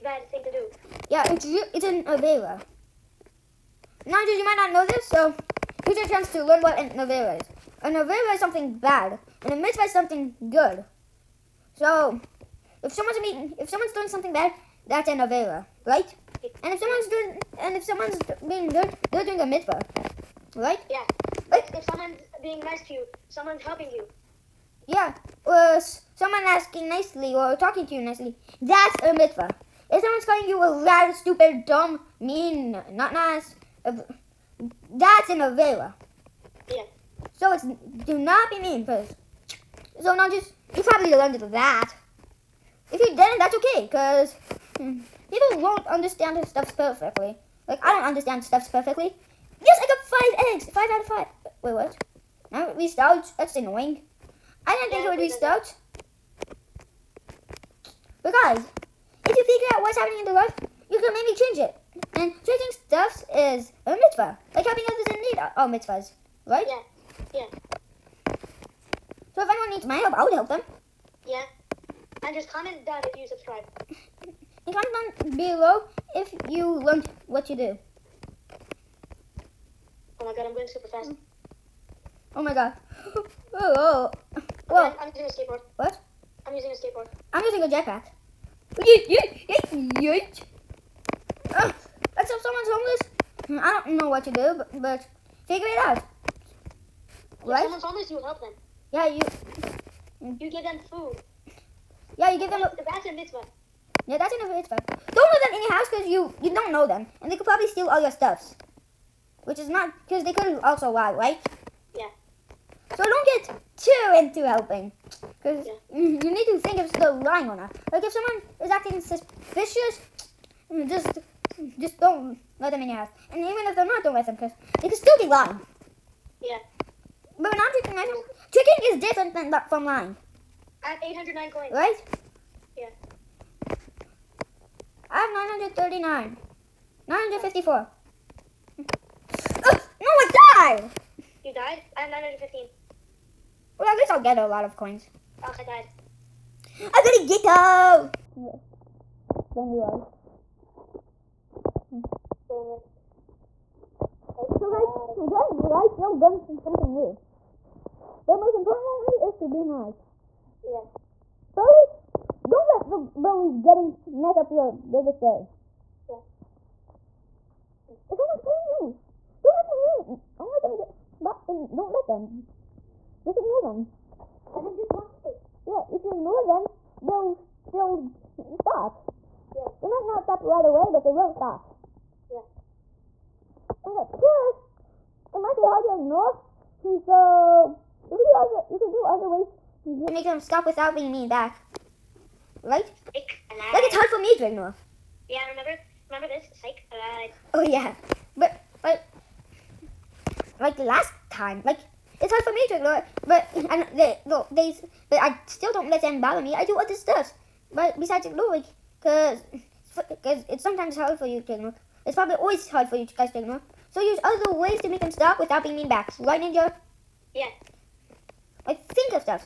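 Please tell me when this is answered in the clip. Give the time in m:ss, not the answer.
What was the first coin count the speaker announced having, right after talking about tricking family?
2:11.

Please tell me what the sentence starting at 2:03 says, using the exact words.
And even if they're not, don't let them because they could still be lying.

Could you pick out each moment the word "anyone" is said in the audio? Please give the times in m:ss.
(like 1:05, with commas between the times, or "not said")
1:09.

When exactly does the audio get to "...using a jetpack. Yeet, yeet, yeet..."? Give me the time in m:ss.
1:27.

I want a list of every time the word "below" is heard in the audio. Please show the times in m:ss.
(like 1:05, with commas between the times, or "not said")
1:15.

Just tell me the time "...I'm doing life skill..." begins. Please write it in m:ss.
2:35.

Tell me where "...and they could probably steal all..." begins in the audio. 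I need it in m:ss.
1:47.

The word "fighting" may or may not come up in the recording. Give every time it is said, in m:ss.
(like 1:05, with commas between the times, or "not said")
not said.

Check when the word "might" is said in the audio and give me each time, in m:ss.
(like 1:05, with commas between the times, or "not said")
0:04, 2:59, 3:05.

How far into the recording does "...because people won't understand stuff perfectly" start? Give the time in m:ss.
0:43.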